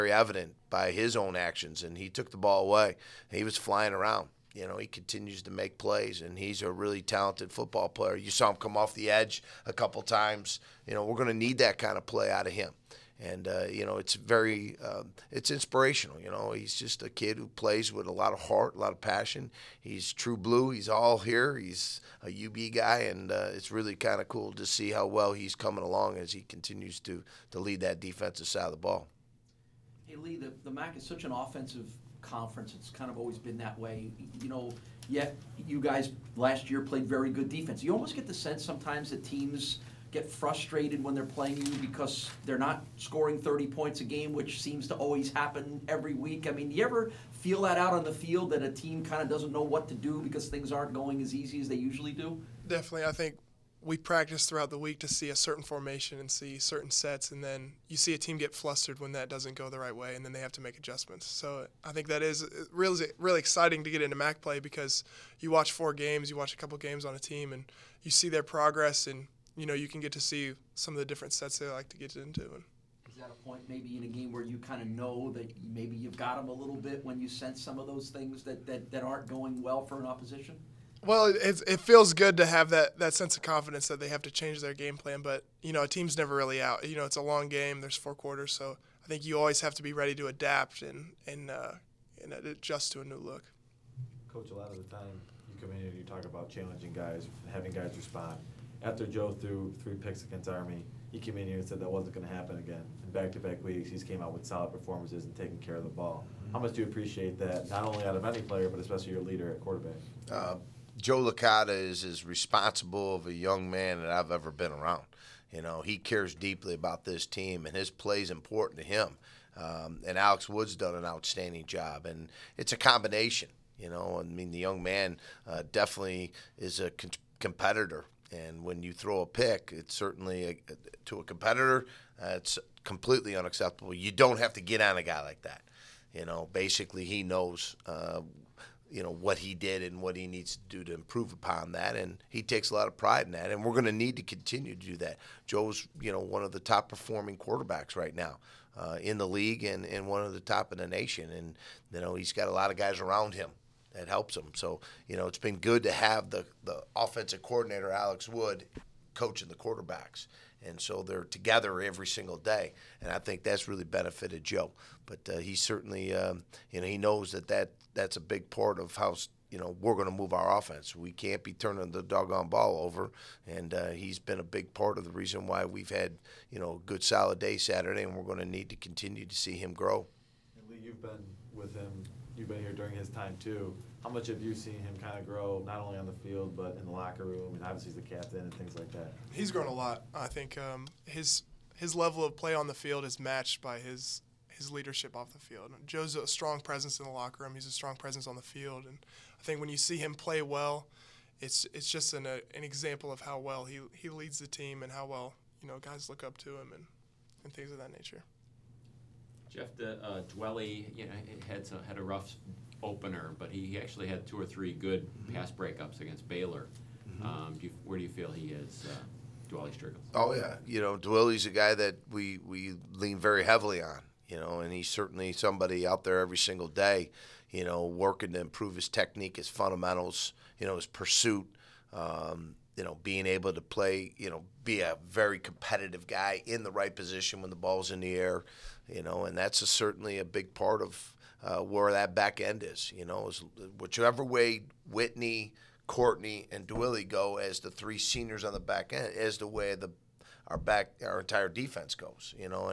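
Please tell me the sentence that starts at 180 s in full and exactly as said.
And Lee, you've been with him you've been here during his time too.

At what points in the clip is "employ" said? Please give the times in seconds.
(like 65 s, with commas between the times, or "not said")
not said.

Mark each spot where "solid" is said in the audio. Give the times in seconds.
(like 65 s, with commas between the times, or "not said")
104 s, 177 s.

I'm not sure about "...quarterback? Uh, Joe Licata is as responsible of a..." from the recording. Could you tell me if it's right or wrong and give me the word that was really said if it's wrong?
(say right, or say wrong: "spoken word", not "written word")
right.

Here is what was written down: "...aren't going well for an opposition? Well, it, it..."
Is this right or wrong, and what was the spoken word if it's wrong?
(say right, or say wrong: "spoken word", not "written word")
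right.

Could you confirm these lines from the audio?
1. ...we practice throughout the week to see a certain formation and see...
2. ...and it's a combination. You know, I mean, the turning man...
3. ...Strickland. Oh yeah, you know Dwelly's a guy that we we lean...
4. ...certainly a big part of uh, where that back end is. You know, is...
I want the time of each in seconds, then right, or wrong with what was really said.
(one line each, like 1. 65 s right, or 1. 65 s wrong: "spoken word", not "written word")
1. 53 s right
2. 122 s wrong: "young", not "turning"
3. 219 s right
4. 239 s right.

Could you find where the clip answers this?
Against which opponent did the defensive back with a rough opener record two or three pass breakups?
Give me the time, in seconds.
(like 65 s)
216 s.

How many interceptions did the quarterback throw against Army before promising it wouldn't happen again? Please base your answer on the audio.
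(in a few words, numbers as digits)
3.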